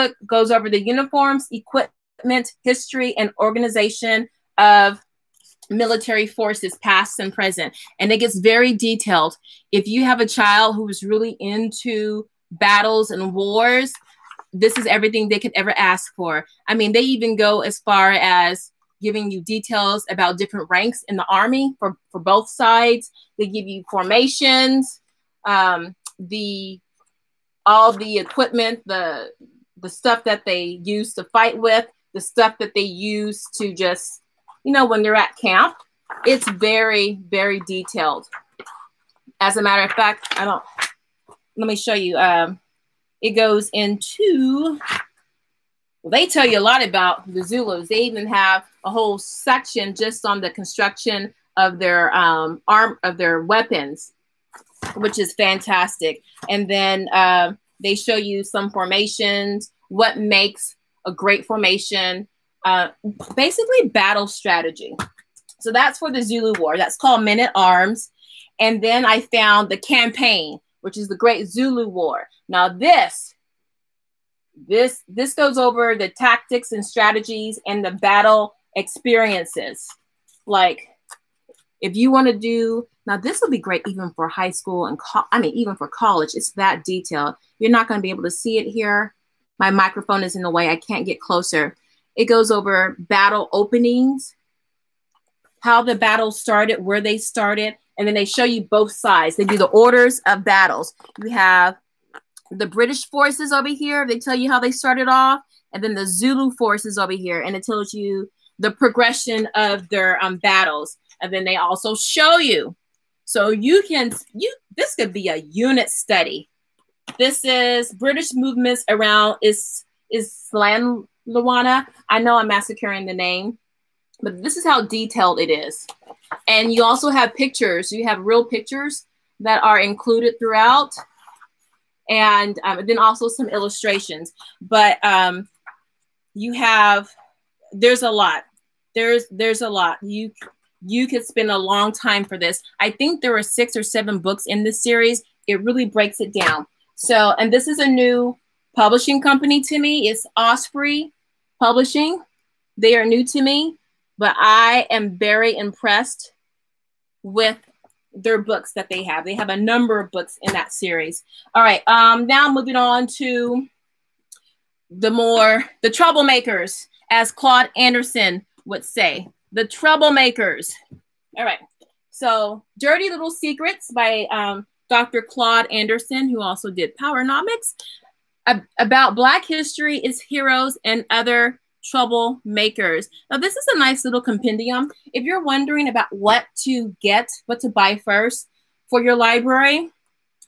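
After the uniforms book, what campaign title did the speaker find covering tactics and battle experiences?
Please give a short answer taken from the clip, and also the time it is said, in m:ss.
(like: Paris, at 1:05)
The Great Zulu War, at 1:11.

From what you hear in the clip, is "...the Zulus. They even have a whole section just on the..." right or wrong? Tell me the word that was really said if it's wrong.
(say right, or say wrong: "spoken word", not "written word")
right.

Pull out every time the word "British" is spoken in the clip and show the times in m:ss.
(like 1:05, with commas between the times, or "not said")
1:42, 1:57.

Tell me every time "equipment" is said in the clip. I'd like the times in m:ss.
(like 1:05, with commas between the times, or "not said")
0:01, 0:28.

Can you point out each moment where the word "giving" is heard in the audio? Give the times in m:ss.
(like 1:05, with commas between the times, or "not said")
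0:19.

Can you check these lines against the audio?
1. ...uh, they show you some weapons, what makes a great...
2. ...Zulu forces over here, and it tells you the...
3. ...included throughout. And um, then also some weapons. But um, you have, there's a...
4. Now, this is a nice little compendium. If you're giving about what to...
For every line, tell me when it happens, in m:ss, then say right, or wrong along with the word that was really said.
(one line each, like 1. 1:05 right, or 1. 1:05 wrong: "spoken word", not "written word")
1. 0:57 wrong: "formations", not "weapons"
2. 1:46 right
3. 2:09 wrong: "illustrations", not "weapons"
4. 3:03 wrong: "wondering", not "giving".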